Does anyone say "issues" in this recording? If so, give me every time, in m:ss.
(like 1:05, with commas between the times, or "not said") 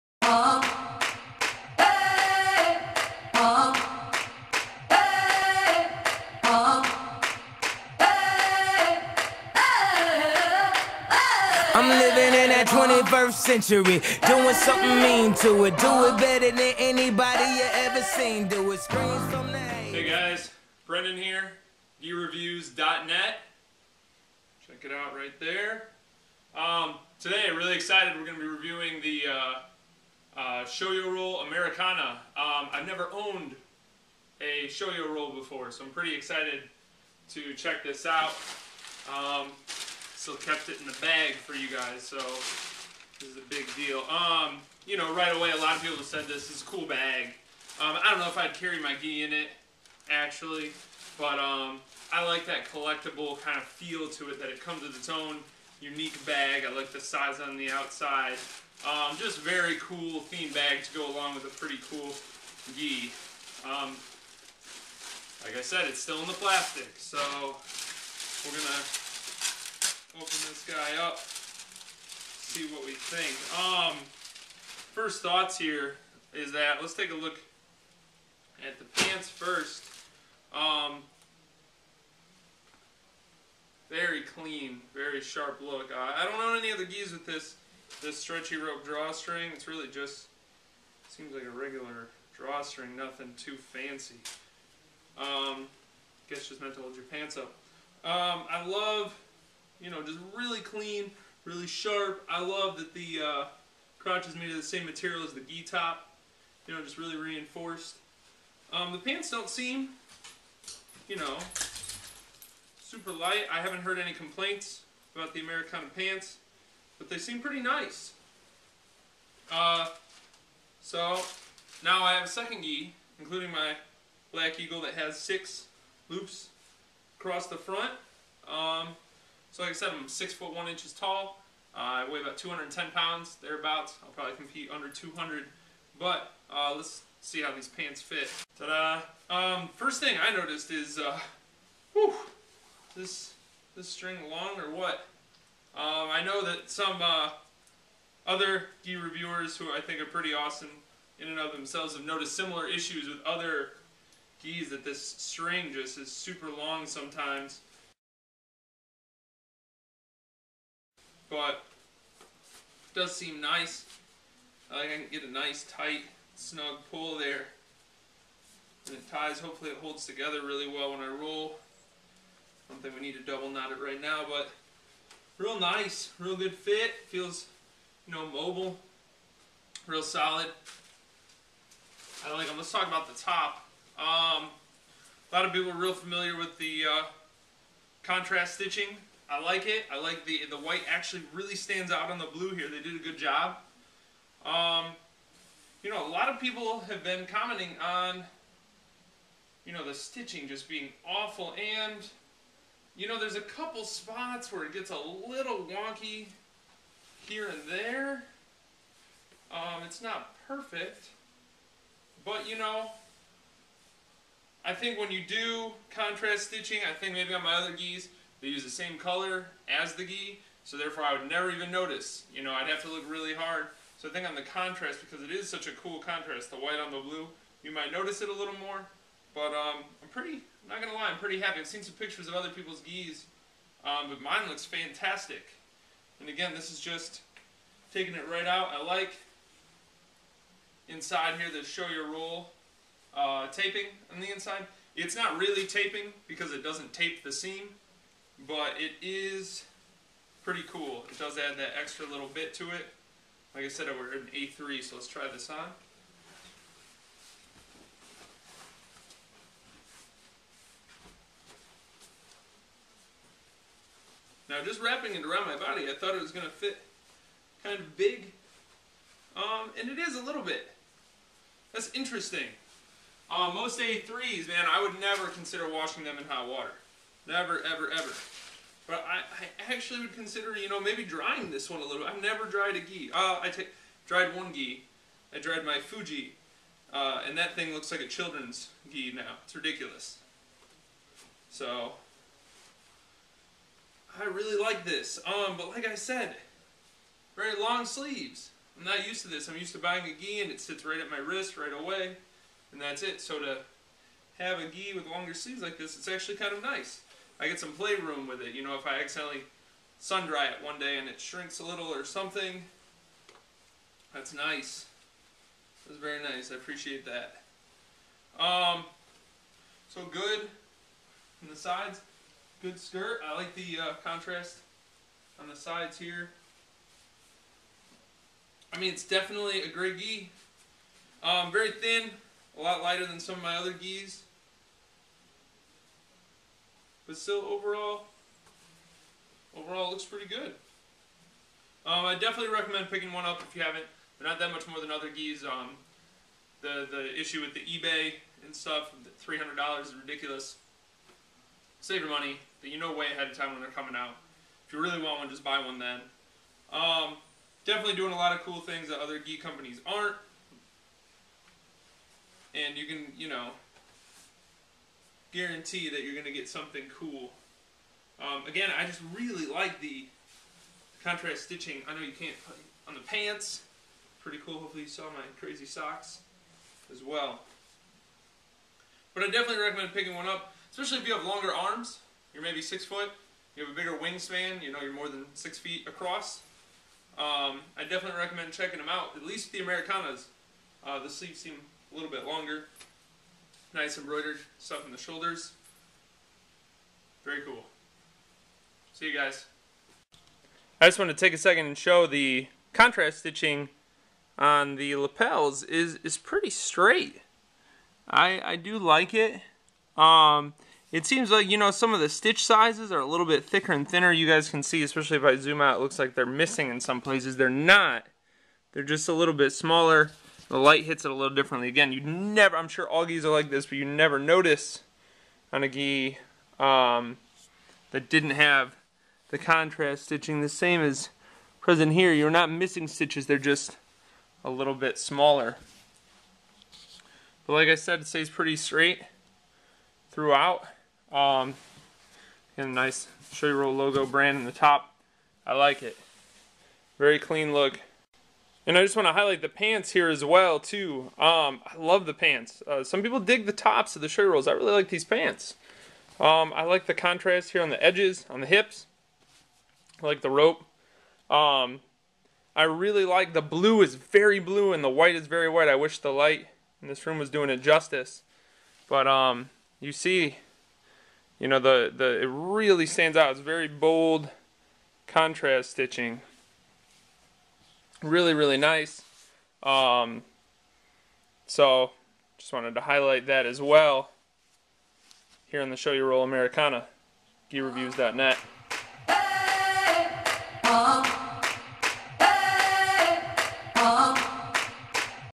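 2:32, 5:47.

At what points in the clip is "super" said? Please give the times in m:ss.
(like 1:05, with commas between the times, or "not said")
1:52, 2:36.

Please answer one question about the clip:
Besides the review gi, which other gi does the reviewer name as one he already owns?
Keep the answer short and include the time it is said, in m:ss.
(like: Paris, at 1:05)
Black Eagle, at 2:04.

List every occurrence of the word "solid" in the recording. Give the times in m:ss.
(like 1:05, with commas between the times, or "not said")
3:00.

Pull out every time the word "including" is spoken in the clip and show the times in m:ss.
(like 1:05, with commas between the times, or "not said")
2:03.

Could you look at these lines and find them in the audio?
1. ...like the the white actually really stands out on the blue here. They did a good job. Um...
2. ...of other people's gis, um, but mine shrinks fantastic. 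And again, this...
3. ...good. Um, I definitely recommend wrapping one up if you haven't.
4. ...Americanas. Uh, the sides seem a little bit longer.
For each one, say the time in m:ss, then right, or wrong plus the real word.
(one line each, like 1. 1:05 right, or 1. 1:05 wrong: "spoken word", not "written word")
1. 3:09 right
2. 3:52 wrong: "looks", not "shrinks"
3. 5:40 wrong: "picking", not "wrapping"
4. 6:29 wrong: "sleeves", not "sides".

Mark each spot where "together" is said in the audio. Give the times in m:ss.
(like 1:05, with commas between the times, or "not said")
2:50.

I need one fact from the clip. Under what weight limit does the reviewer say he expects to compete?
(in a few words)
200.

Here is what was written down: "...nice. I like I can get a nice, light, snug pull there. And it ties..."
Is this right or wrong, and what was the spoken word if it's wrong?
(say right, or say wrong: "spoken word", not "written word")
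wrong: "tight", not "light".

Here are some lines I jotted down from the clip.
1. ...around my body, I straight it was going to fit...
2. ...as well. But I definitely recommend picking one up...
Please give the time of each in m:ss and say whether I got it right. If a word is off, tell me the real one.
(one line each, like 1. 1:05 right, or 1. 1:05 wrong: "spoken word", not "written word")
1. 4:25 wrong: "thought", not "straight"
2. 6:16 right.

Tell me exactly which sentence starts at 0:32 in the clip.
Um, I've never owned a Shoyoroll before, so I'm pretty excited to check this out.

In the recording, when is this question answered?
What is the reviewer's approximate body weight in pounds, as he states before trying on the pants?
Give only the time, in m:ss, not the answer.
2:12.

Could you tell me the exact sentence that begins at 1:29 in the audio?
It's really just seems like a regular drawstring, nothing too fancy.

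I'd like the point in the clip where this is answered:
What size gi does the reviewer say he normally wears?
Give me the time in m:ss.
4:14.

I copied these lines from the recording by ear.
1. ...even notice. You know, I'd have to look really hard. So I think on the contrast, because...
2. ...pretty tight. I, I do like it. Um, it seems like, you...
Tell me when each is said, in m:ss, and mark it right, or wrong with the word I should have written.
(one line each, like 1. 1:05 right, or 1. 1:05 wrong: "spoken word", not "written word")
1. 3:41 right
2. 6:46 wrong: "straight", not "tight".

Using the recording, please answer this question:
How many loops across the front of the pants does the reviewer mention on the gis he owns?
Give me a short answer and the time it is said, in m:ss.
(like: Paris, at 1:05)
6, at 2:05.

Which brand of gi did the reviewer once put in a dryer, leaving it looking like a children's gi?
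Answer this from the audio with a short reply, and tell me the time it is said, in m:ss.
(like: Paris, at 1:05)
Fuji, at 4:45.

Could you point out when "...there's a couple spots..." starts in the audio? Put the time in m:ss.
3:23.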